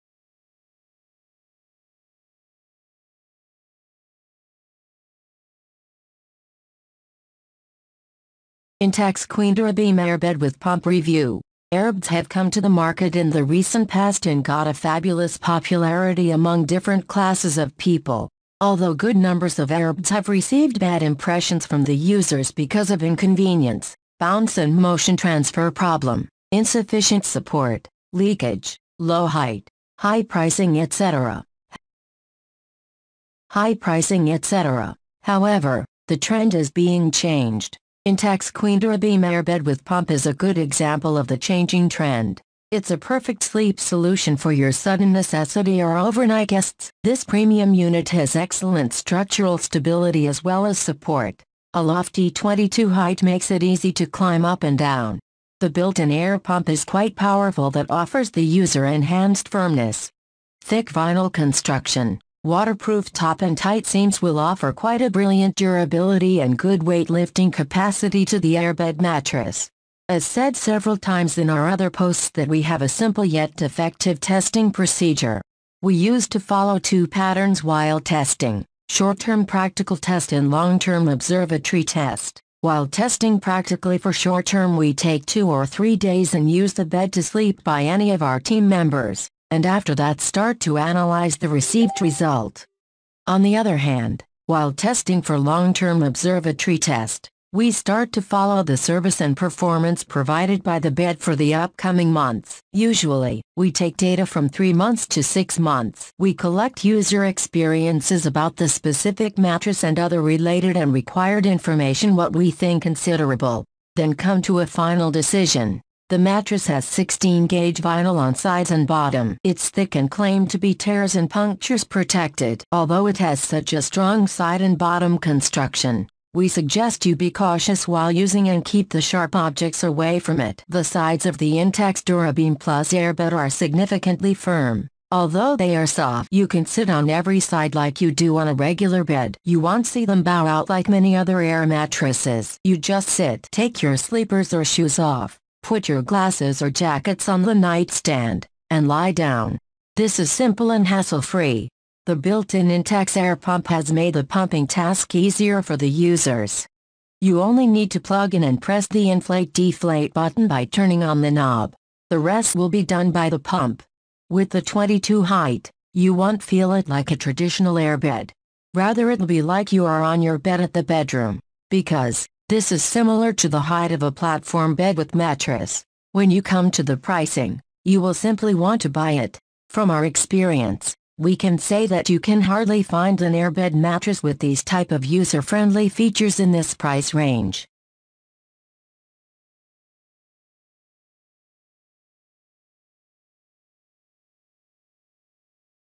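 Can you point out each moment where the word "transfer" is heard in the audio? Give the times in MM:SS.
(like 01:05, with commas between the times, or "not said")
00:25.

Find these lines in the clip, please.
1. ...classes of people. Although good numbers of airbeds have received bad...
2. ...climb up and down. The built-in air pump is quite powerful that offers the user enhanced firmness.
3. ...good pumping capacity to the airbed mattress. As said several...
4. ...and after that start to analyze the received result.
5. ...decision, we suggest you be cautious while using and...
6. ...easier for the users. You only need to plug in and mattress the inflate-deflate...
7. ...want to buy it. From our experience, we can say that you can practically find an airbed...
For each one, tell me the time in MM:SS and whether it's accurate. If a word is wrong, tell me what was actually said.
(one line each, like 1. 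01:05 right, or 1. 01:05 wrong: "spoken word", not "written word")
1. 00:17 right
2. 00:54 right
3. 01:06 wrong: "weightlifting", not "pumping"
4. 01:29 right
5. 02:05 wrong: "construction", not "decision"
6. 02:35 wrong: "press", not "mattress"
7. 02:58 wrong: "hardly", not "practically".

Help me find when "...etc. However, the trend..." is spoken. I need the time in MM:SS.
00:34.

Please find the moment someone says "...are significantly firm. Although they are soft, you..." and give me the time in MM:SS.
02:13.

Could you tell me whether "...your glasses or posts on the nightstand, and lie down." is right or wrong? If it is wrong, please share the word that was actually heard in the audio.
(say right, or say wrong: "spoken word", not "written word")
wrong: "jackets", not "posts".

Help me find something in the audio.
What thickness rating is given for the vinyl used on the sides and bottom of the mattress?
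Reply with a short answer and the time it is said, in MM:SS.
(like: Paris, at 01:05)
16-gauge, at 01:56.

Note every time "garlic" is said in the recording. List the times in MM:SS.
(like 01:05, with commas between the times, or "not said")
not said.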